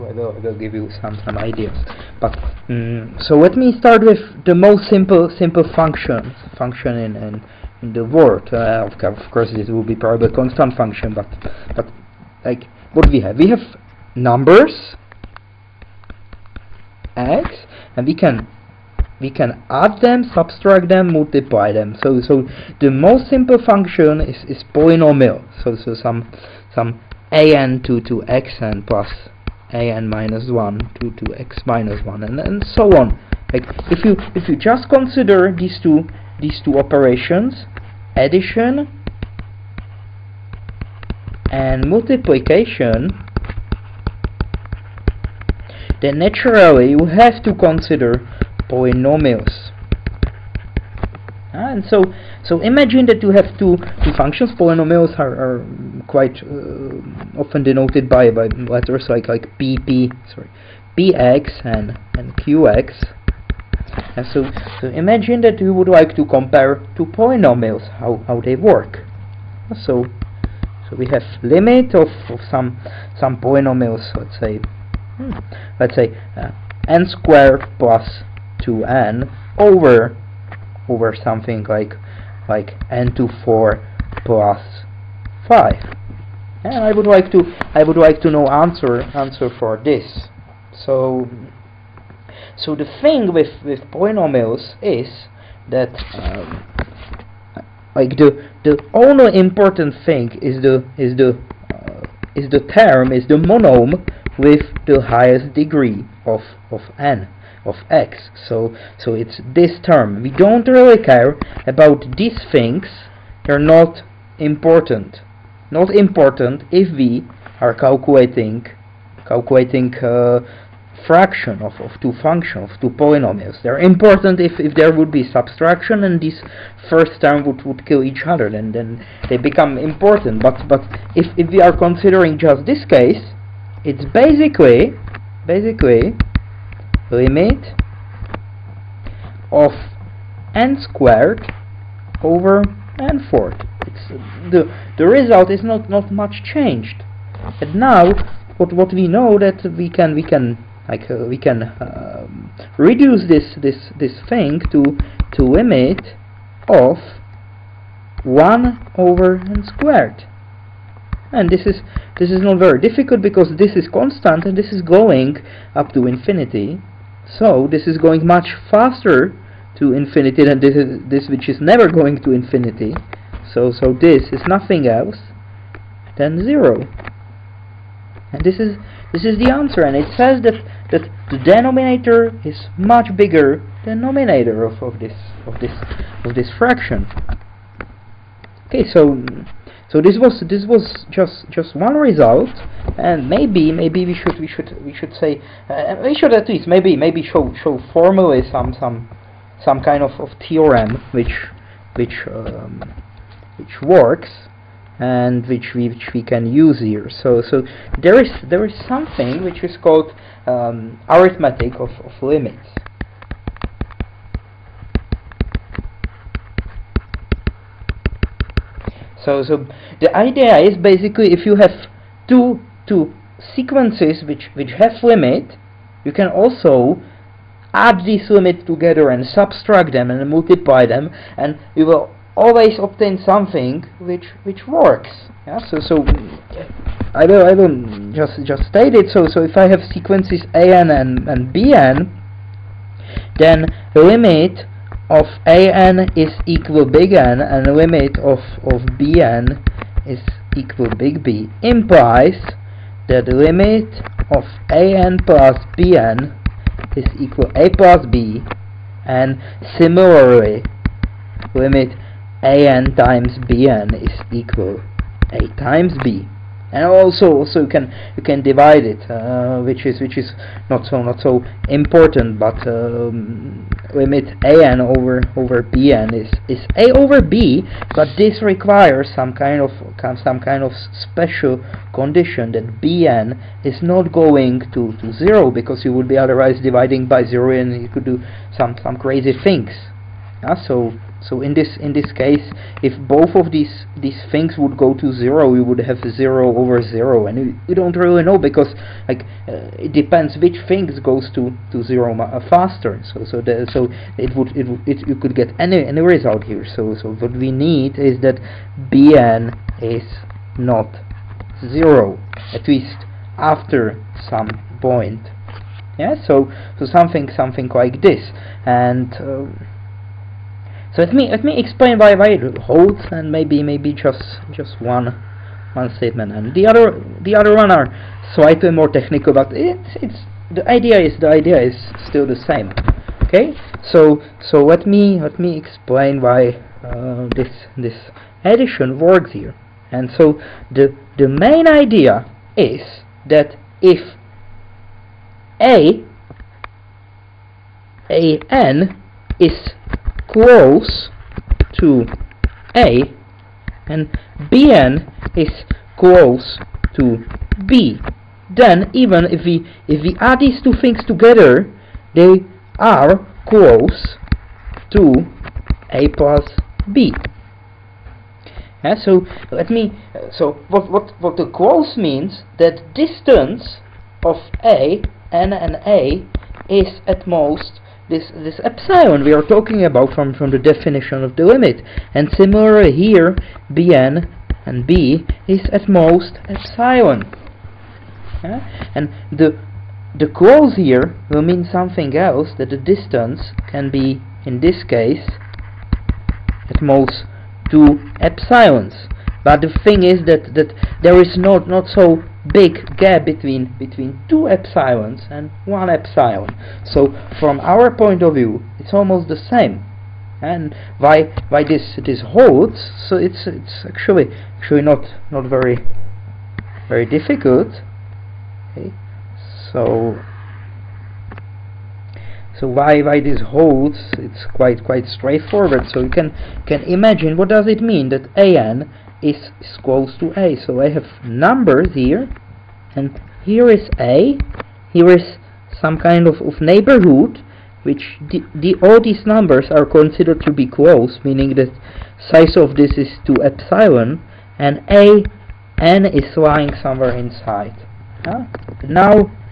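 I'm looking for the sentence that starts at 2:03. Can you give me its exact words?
They're important if, if there would be subtraction and this first term would, would kill each other, then, then they become important.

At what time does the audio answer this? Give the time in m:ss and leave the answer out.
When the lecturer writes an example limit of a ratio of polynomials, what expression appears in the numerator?
1:16.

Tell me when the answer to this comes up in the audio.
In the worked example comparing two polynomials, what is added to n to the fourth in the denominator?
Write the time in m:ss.
1:22.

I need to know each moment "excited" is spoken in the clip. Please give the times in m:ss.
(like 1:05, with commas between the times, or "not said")
not said.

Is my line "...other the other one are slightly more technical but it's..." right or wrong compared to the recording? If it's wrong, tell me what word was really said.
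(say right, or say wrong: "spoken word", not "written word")
right.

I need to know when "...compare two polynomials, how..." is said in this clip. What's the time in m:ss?
1:06.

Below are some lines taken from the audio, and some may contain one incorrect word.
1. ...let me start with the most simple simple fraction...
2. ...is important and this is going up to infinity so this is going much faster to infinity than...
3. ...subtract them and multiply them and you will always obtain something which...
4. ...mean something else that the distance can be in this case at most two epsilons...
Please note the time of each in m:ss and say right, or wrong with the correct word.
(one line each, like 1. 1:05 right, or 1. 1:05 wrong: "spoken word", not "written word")
1. 0:03 wrong: "function", not "fraction"
2. 2:43 wrong: "constant", not "important"
3. 3:49 right
4. 6:31 right.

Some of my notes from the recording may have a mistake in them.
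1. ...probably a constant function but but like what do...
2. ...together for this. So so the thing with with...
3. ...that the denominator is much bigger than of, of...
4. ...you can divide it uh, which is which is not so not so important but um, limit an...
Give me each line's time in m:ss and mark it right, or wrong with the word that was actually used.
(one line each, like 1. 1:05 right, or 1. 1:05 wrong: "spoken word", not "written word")
1. 0:09 right
2. 1:29 wrong: "answer", not "together"
3. 3:00 right
4. 4:28 right.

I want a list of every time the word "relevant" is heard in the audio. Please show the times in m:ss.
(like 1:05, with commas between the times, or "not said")
not said.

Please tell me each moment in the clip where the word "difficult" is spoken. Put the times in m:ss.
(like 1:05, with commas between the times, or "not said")
2:42, 6:57.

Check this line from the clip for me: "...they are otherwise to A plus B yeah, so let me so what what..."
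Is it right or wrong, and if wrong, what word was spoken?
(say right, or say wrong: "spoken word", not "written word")
wrong: "close", not "otherwise".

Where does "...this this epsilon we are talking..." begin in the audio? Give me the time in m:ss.
6:18.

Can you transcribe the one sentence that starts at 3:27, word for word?
So so there is there is something which is called um, arithmetic of, of limits.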